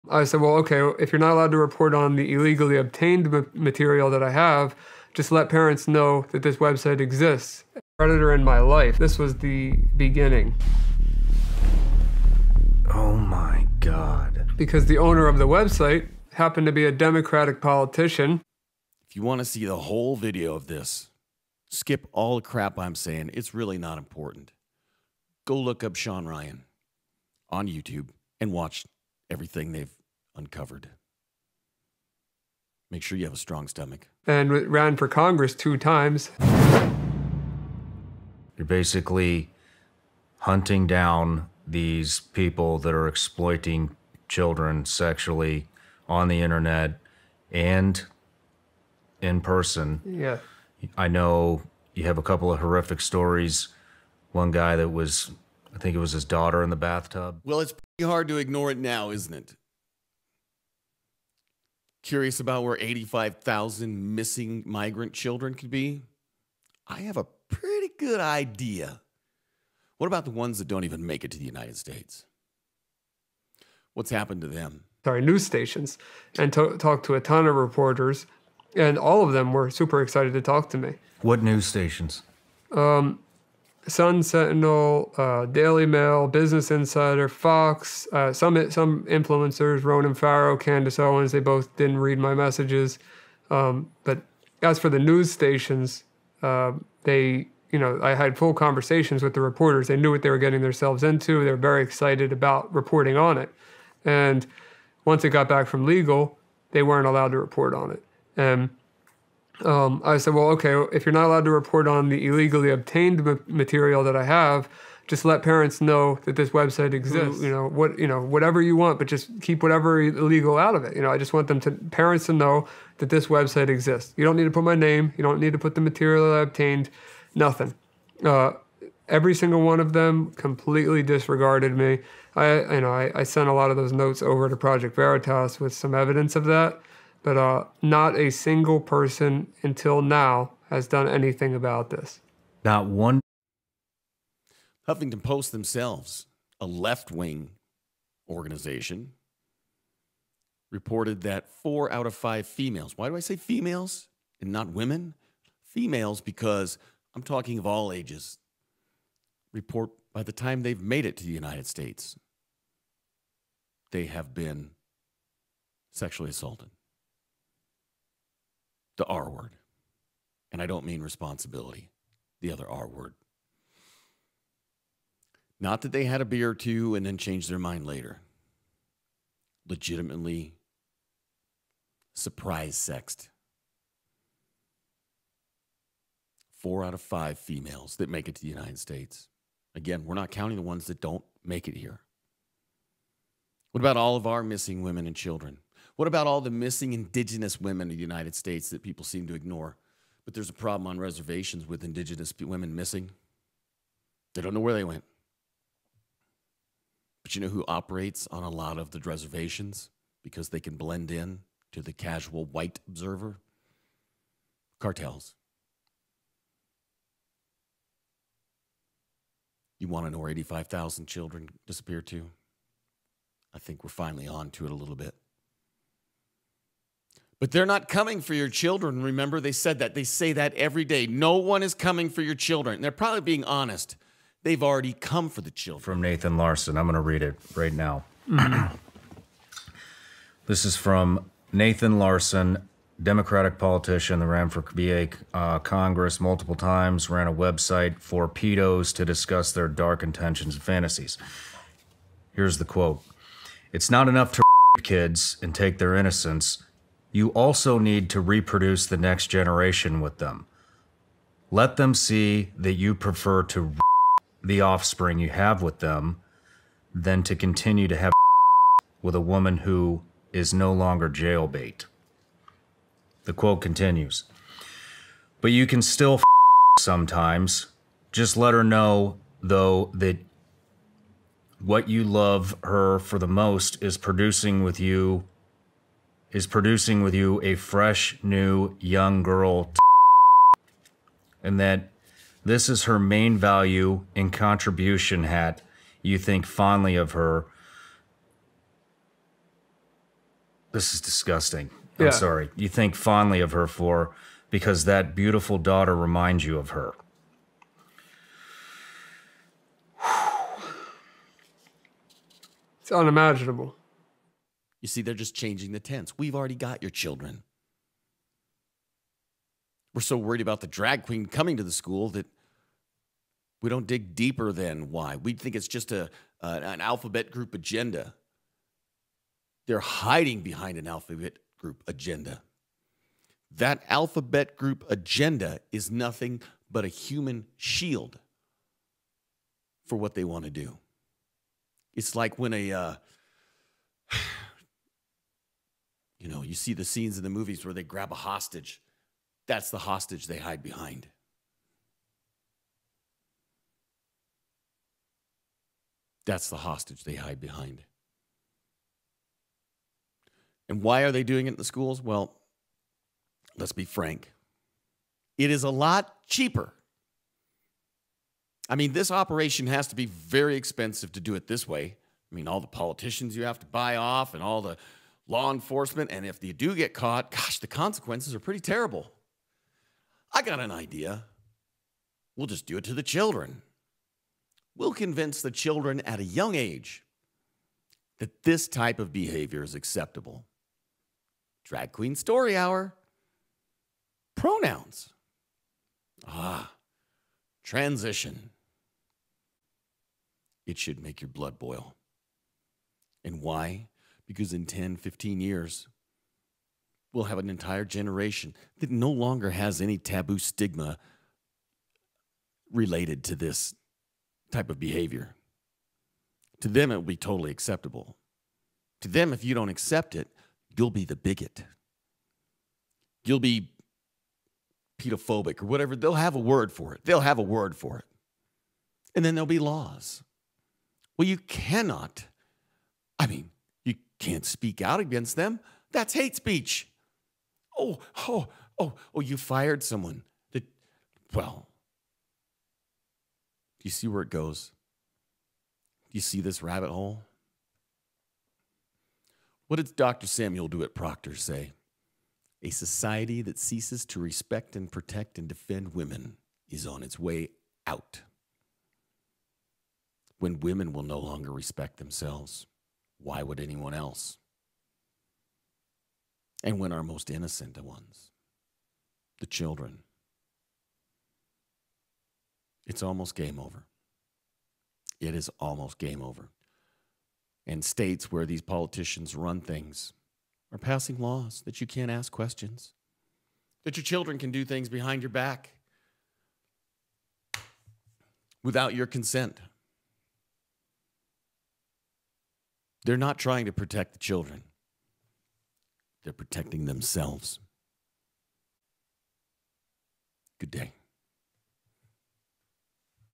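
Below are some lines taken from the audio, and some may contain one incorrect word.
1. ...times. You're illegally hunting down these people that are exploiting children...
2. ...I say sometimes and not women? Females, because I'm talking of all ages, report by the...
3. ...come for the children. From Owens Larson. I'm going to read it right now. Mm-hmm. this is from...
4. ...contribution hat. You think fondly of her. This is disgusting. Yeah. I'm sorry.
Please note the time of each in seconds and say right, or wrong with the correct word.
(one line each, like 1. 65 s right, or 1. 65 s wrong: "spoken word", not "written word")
1. 35 s wrong: "basically", not "illegally"
2. 153 s wrong: "females", not "sometimes"
3. 234 s wrong: "Nathan", not "Owens"
4. 294 s right.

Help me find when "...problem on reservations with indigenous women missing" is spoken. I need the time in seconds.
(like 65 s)
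200 s.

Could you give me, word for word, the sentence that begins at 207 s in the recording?
But you know who operates on a lot of the reservations because they can blend in to the casual white observer?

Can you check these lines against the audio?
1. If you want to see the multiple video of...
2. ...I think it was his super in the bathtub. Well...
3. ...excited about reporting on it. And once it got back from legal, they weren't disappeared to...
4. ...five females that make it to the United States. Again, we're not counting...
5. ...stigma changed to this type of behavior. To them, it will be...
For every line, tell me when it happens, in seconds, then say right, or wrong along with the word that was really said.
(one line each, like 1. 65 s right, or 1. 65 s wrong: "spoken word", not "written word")
1. 19 s wrong: "whole", not "multiple"
2. 55 s wrong: "daughter", not "super"
3. 101 s wrong: "allowed", not "disappeared"
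4. 187 s right
5. 410 s wrong: "related", not "changed".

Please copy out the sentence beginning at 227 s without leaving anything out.
But they're not coming for your children.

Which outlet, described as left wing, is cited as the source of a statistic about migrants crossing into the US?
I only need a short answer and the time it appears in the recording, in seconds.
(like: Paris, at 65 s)
Huffington Post, at 144 s.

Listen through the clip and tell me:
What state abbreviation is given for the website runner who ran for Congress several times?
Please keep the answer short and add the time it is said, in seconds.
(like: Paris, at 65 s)
VA, at 244 s.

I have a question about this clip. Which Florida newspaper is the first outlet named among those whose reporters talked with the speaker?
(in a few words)
Sun Sentinel.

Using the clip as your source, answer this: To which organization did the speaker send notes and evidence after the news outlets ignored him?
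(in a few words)
Project Veritas.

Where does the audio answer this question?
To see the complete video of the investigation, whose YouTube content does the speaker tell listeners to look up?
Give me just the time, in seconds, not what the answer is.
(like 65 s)
25 s.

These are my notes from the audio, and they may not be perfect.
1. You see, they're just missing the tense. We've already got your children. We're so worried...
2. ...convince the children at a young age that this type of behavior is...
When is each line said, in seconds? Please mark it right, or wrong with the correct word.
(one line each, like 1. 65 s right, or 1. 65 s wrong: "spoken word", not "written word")
1. 314 s wrong: "changing", not "missing"
2. 384 s right.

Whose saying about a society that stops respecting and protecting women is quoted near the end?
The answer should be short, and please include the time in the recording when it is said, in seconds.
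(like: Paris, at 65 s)
Dr. Samuel DeWitt Proctor, at 449 s.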